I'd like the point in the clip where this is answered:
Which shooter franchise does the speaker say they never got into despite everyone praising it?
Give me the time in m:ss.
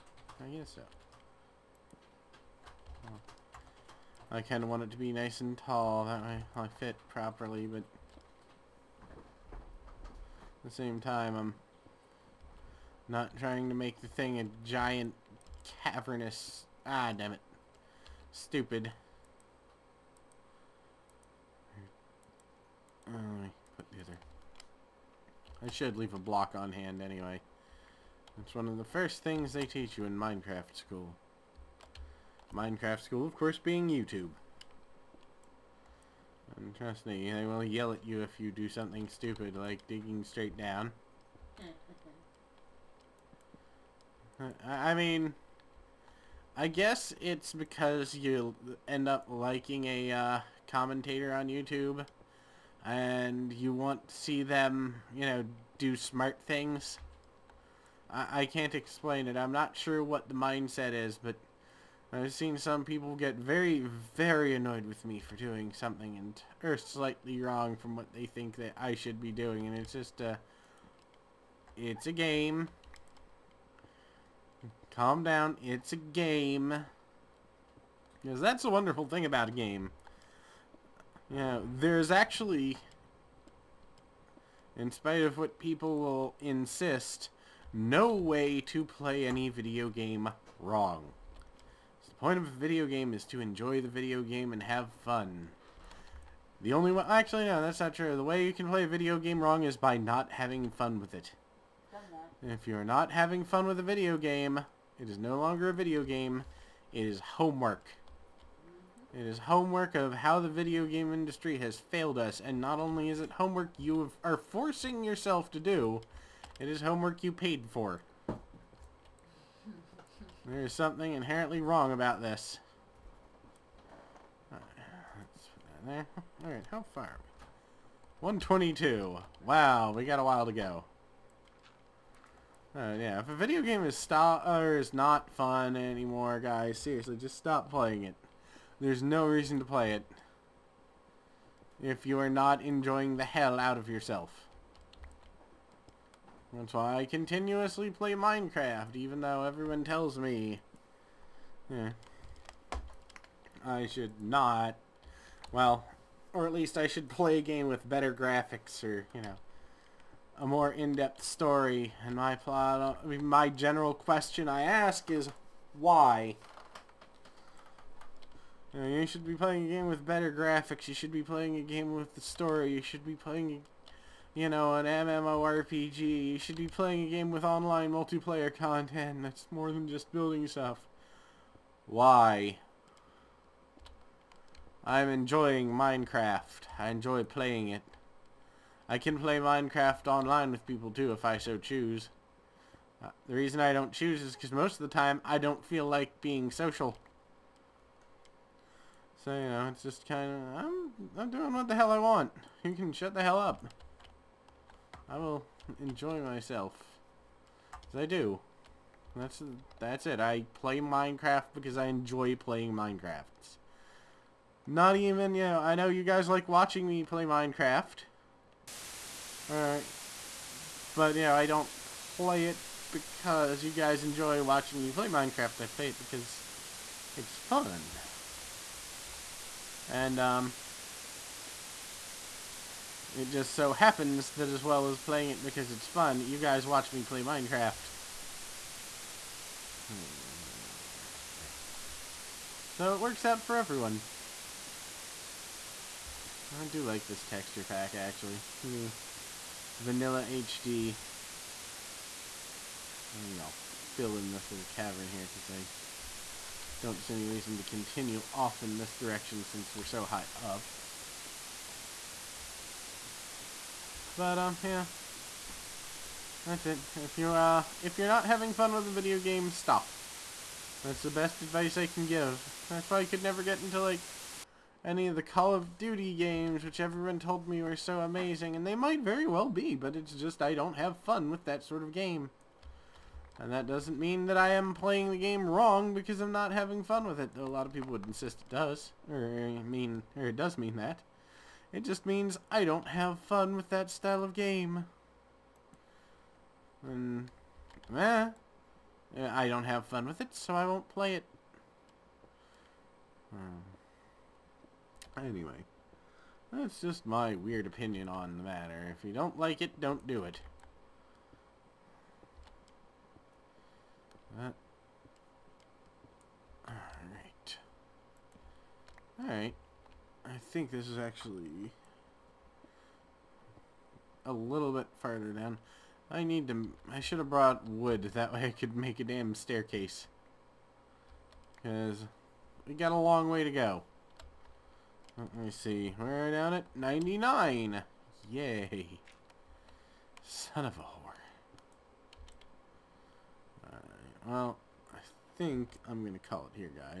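4:35.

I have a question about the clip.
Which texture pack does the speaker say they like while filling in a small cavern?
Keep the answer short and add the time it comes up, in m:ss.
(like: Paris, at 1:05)
Vanilla HD, at 4:08.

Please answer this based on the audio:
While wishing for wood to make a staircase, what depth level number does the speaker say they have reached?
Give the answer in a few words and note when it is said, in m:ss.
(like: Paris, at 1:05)
99, at 5:36.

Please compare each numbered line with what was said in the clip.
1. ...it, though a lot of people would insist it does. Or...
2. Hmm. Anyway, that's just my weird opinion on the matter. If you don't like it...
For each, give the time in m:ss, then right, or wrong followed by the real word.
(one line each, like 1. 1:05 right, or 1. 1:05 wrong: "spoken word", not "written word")
1. 4:47 right
2. 5:03 right.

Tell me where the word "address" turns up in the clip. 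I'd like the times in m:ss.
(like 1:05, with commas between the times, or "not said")
not said.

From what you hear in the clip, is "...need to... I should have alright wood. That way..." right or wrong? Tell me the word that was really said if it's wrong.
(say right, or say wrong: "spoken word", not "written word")
wrong: "brought", not "alright".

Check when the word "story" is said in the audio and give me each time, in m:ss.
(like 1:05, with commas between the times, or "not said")
2:41, 2:52.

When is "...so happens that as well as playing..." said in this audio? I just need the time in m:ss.
3:53.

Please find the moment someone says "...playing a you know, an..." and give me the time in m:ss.
2:53.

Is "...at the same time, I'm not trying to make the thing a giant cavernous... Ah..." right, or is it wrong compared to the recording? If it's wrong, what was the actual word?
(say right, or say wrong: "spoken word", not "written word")
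right.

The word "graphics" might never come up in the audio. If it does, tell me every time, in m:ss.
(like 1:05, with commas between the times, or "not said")
2:38, 2:50.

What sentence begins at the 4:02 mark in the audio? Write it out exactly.
So it works out for everyone.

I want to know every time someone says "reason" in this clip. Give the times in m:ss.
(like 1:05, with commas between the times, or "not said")
2:19, 3:13, 4:17.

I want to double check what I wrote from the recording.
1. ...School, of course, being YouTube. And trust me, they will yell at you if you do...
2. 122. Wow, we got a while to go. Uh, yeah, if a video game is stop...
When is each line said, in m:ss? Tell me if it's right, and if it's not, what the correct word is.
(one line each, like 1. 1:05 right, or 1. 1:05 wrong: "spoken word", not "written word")
1. 0:33 right
2. 2:08 right.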